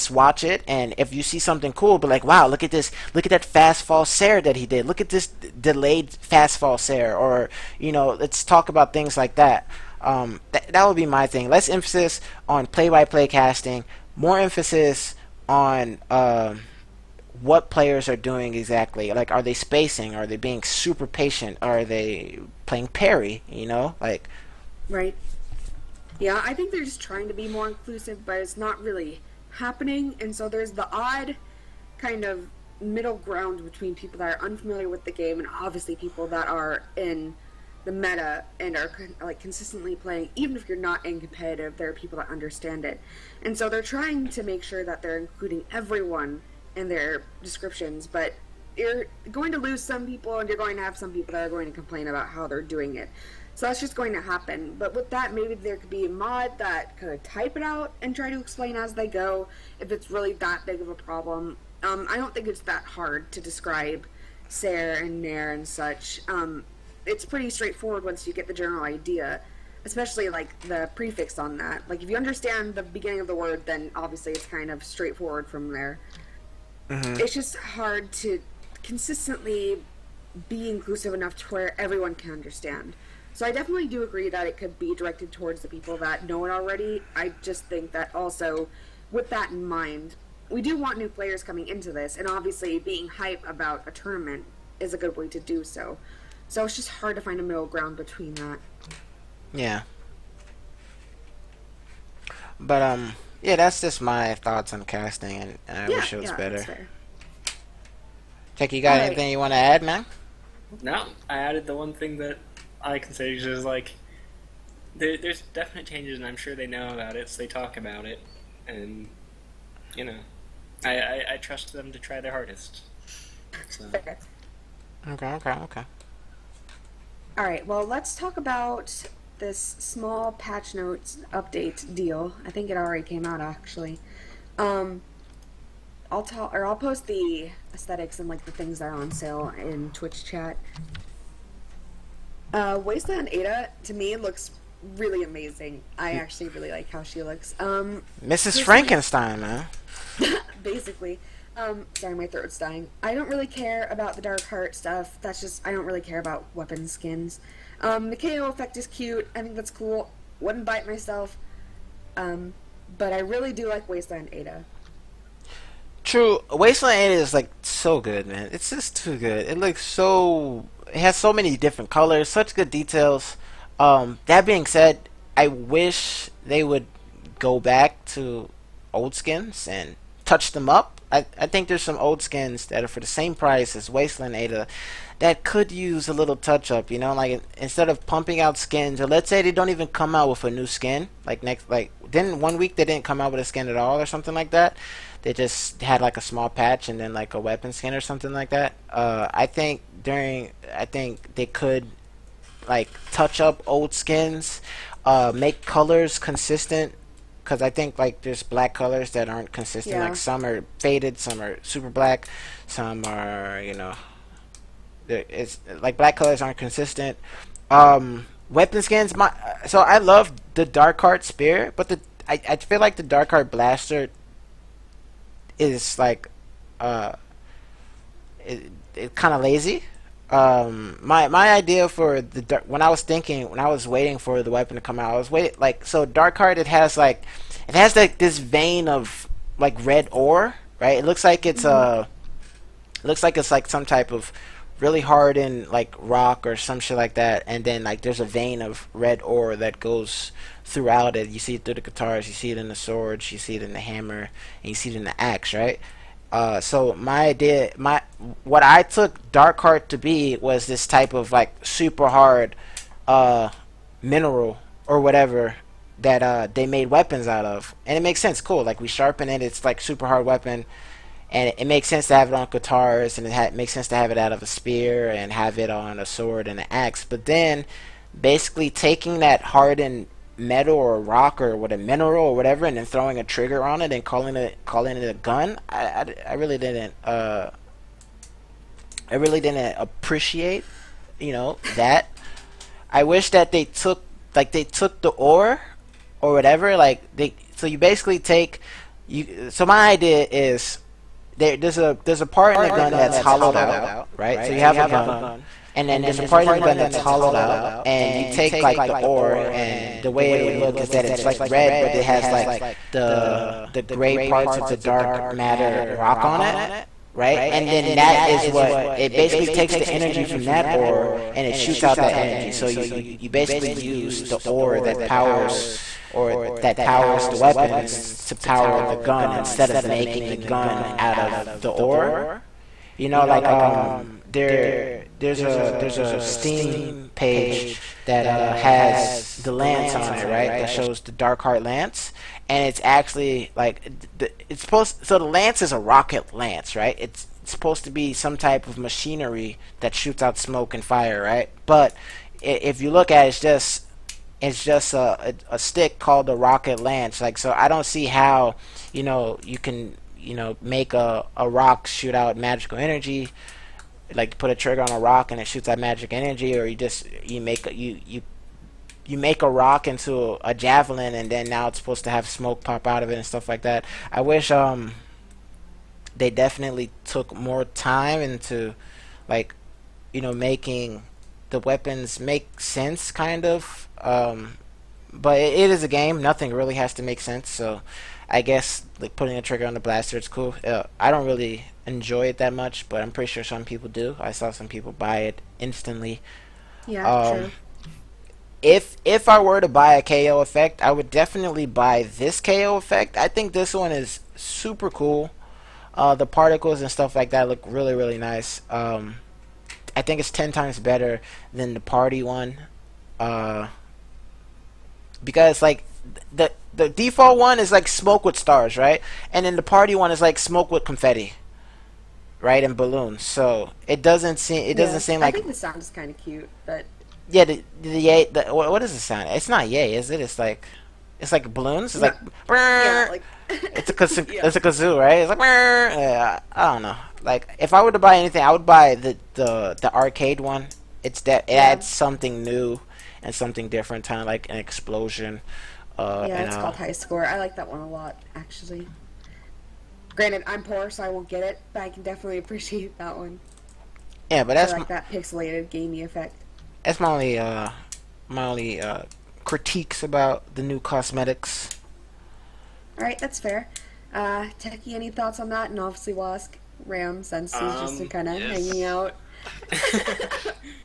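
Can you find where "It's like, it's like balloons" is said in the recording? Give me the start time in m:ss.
7:10.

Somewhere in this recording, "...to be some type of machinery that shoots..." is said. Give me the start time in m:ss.
5:47.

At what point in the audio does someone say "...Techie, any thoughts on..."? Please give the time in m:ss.
7:44.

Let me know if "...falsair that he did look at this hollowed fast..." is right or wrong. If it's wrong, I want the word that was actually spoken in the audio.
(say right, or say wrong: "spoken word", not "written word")
wrong: "delayed", not "hollowed".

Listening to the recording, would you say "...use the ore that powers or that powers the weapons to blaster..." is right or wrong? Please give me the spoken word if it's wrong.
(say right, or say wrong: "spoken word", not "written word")
wrong: "power", not "blaster".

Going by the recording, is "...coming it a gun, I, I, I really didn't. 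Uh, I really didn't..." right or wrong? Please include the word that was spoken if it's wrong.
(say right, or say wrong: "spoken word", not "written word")
wrong: "calling", not "coming".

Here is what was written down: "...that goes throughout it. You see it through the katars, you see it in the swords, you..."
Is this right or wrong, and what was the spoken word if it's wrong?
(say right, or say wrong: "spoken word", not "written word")
right.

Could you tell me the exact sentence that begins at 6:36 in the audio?
Yeah, um, true if if I were to buy a KO effect, I would definitely buy this KO effect.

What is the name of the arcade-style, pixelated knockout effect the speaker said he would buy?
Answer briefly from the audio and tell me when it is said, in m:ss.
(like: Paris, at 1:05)
High Score, at 7:26.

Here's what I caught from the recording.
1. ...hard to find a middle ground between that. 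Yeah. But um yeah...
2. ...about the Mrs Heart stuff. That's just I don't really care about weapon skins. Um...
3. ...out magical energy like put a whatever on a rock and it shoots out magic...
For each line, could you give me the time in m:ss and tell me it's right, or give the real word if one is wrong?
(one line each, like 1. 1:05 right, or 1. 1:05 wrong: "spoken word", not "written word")
1. 1:36 right
2. 2:33 wrong: "Dark", not "Mrs"
3. 6:02 wrong: "trigger", not "whatever".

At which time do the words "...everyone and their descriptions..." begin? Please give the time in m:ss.
0:45.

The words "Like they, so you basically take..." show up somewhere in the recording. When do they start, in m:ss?
4:56.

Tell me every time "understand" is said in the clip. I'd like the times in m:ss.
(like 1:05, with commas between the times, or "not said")
0:42, 1:12, 1:22.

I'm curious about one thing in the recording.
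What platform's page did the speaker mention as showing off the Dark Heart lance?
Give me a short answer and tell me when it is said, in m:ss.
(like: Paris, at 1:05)
Steam, at 5:36.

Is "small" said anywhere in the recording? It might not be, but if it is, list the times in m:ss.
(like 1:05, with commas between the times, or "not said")
2:09, 3:16.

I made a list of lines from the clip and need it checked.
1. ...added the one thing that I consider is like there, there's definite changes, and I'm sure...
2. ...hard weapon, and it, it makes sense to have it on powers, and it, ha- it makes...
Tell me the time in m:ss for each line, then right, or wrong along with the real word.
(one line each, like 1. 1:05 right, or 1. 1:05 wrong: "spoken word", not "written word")
1. 1:51 right
2. 4:30 wrong: "katars", not "powers".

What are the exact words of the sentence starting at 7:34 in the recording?
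Yeah, but that's I like that pixelated gamey effect that's my only uh, my only uh, critiques about the new cosmetics.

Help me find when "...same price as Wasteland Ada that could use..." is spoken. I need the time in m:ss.
3:03.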